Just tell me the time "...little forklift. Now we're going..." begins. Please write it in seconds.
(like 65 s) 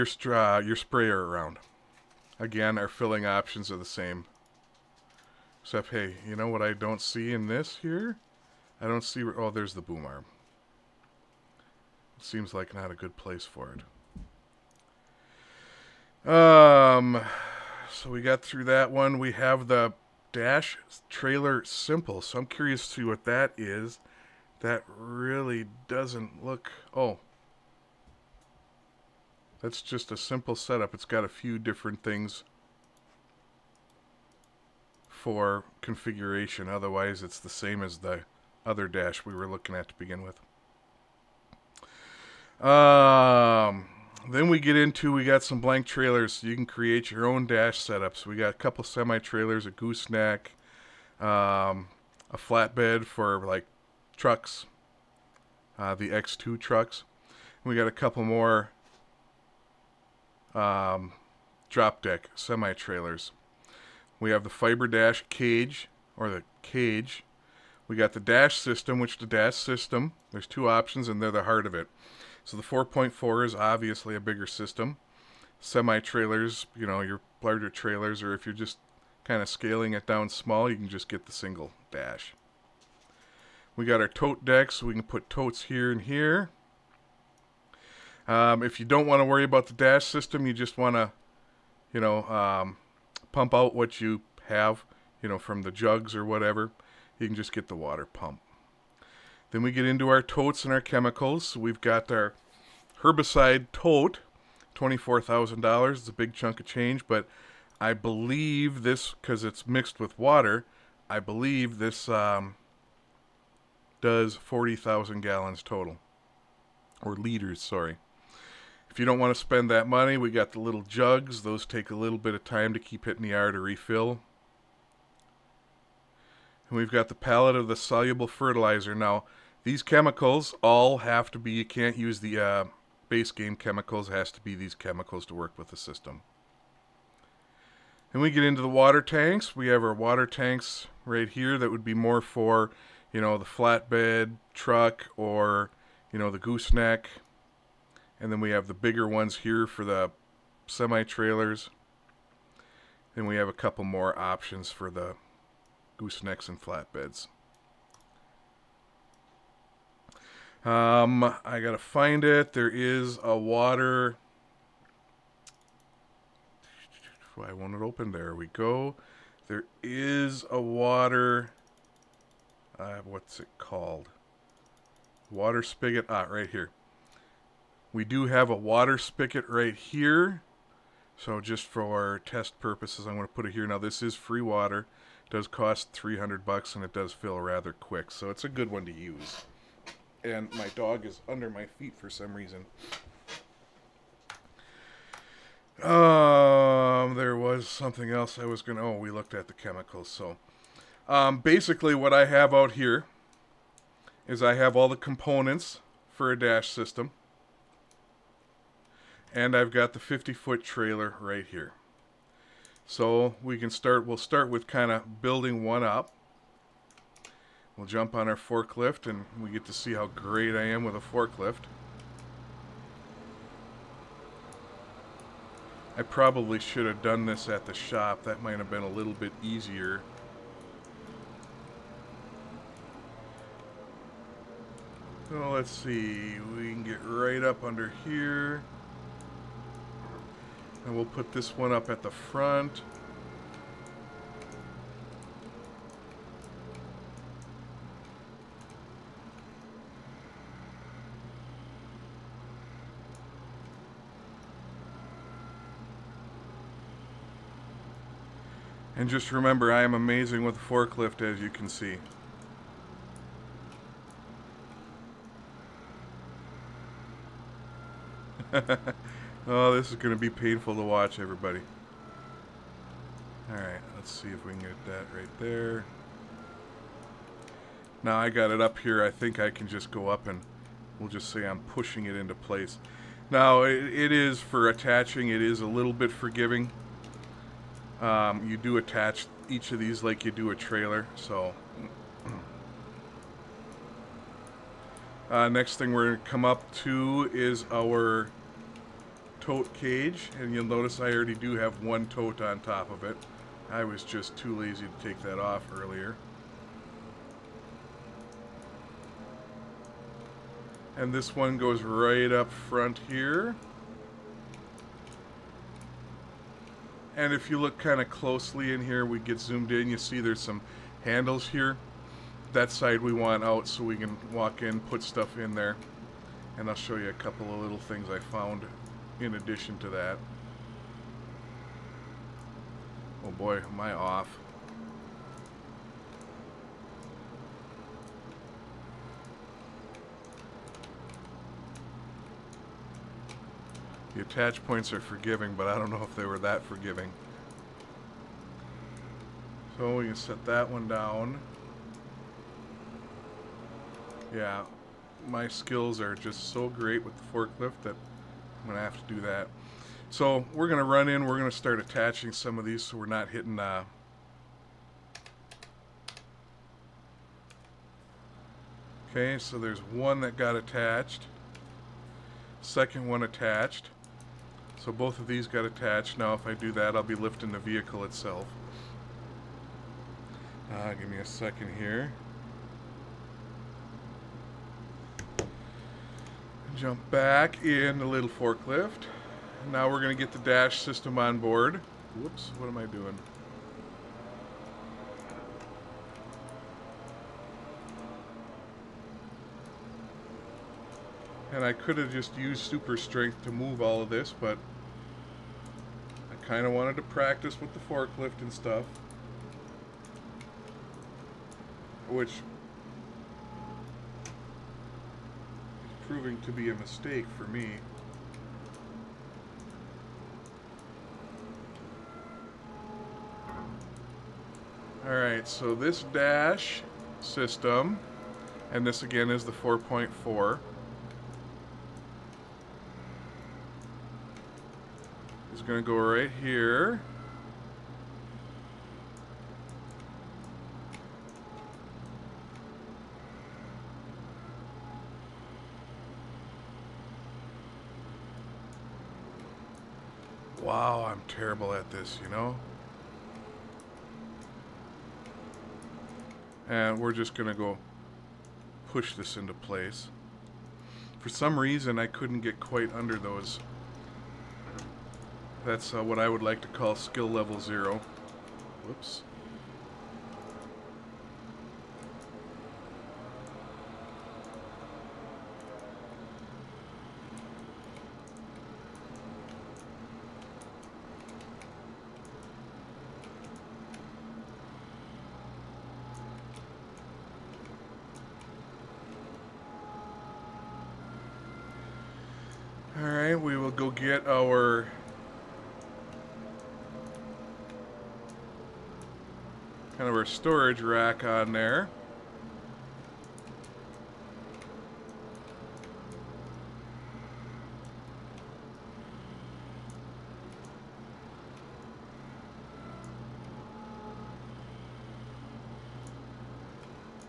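388 s.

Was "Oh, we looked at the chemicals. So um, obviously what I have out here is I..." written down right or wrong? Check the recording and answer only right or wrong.
wrong.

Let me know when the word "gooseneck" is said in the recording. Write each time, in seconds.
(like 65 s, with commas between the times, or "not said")
49 s, 146 s, 155 s.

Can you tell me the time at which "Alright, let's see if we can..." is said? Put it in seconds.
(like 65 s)
273 s.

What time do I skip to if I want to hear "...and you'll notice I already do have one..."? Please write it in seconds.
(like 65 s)
300 s.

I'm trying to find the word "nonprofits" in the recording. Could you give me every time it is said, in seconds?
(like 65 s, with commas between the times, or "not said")
not said.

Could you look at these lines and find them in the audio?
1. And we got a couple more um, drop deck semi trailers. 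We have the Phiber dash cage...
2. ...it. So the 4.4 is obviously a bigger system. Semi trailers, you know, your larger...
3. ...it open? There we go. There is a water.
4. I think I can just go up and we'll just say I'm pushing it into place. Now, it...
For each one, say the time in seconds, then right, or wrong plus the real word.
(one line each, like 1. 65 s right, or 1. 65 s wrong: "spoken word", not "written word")
1. 57 s right
2. 71 s right
3. 167 s right
4. 279 s right.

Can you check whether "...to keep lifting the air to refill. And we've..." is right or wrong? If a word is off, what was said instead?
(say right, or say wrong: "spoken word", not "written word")
wrong: "hitting", not "lifting".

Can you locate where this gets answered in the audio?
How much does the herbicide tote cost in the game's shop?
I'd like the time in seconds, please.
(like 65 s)
104 s.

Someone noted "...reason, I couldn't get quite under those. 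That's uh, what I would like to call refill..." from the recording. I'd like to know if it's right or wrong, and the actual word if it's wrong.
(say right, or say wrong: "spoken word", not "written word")
wrong: "skill", not "refill".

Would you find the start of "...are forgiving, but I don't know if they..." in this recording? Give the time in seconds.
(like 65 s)
344 s.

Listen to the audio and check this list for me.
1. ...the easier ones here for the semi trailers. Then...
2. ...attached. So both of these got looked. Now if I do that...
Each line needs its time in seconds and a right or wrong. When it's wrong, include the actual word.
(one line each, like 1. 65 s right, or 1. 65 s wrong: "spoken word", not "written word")
1. 148 s wrong: "bigger", not "easier"
2. 373 s wrong: "attached", not "looked".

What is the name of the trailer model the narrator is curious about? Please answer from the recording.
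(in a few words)
Dash Trailer Simple.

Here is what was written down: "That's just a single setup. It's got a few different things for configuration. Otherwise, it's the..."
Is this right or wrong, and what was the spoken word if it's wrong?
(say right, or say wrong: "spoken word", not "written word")
wrong: "simple", not "single".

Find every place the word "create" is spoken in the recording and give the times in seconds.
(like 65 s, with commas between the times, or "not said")
46 s.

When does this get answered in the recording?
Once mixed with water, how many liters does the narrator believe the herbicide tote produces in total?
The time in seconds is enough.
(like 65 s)
114 s.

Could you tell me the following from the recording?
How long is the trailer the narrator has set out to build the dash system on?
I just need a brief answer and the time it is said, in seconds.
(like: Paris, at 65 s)
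50 foot, at 209 s.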